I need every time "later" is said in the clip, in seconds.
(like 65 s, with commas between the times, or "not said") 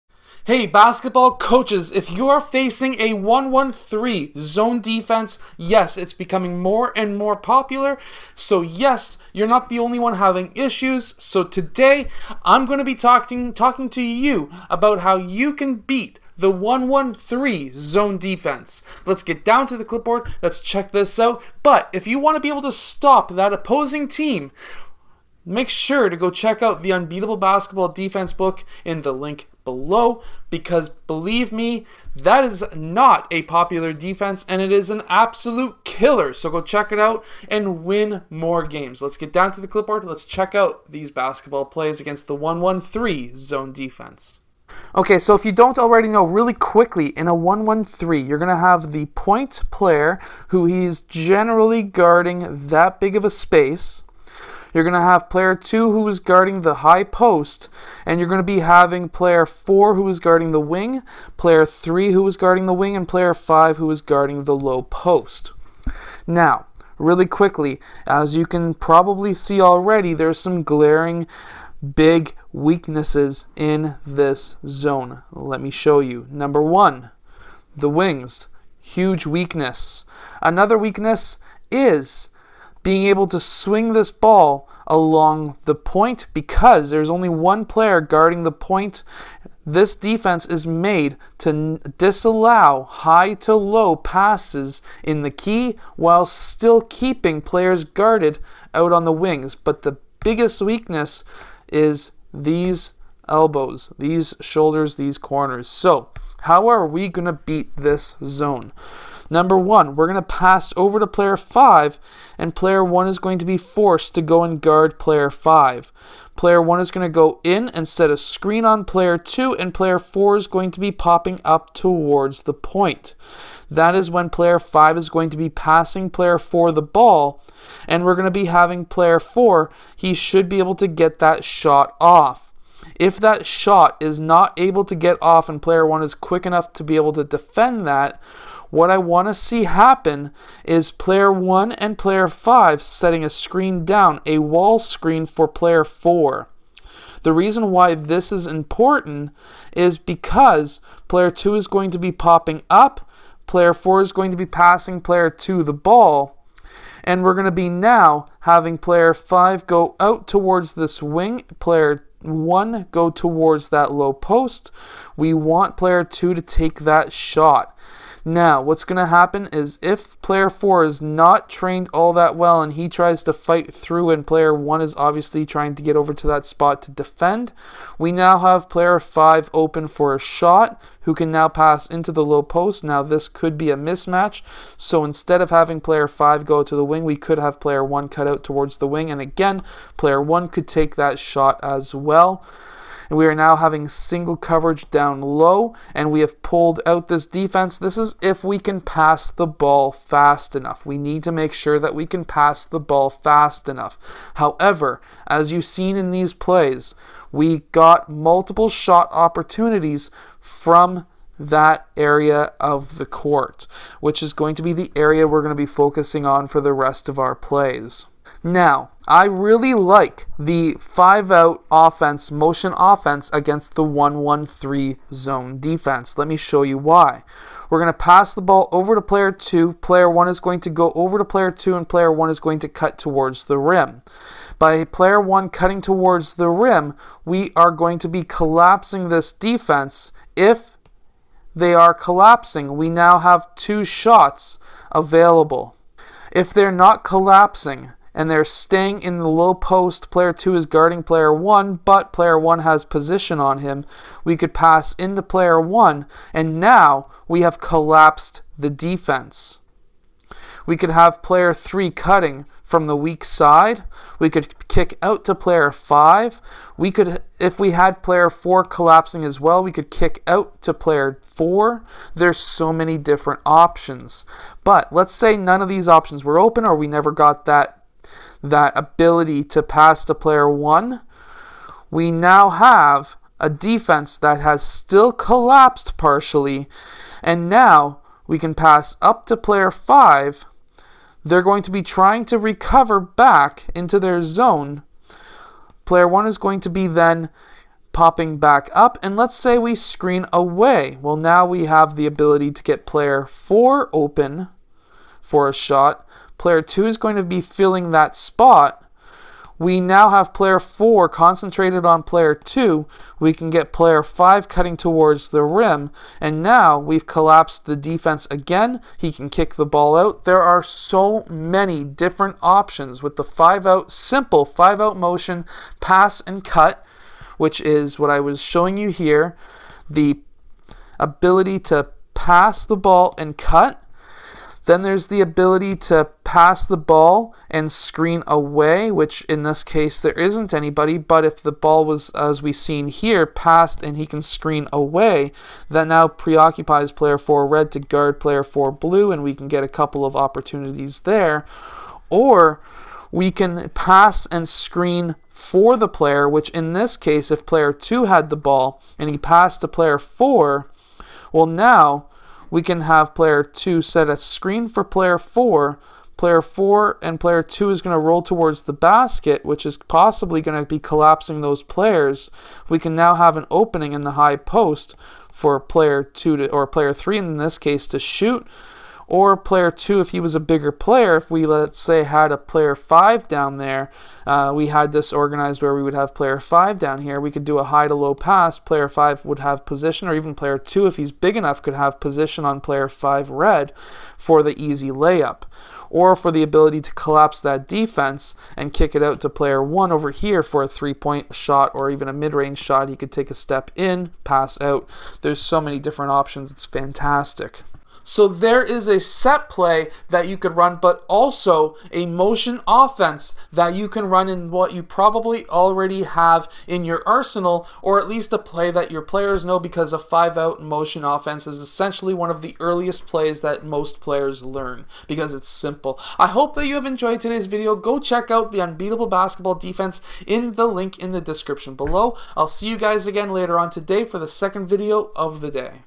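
433 s.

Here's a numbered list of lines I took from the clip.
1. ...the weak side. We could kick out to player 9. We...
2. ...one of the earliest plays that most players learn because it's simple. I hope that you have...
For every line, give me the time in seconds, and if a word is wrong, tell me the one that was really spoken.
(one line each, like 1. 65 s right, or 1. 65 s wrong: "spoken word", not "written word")
1. 262 s wrong: "5", not "9"
2. 422 s right.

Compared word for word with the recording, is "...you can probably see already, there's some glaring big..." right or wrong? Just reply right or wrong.
right.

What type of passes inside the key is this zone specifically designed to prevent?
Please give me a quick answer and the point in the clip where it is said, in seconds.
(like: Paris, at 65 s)
High to low passes, at 92 s.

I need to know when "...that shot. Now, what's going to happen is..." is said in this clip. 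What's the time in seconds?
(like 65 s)
166 s.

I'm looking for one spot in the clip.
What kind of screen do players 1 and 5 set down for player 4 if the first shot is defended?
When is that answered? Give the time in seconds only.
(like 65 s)
144 s.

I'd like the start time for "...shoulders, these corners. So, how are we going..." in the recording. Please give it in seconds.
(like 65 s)
104 s.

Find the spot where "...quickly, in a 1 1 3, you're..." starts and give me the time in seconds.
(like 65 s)
46 s.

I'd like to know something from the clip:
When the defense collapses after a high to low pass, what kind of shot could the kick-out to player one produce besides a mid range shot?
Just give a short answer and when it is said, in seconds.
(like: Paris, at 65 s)
Three point shot, at 400 s.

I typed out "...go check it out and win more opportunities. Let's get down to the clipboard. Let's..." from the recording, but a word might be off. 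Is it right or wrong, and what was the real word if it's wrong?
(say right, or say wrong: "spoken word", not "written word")
wrong: "games", not "opportunities".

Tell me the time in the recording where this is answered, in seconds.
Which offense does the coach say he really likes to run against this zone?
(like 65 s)
220 s.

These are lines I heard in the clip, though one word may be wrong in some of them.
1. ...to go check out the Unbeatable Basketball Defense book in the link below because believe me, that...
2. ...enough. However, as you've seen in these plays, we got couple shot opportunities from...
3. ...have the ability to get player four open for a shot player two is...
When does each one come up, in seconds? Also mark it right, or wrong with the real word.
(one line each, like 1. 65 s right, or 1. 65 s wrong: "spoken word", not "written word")
1. 26 s right
2. 203 s wrong: "multiple", not "couple"
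3. 301 s right.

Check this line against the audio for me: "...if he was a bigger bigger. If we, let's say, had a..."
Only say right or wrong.
wrong.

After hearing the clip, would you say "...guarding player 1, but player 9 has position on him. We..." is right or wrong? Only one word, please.
wrong.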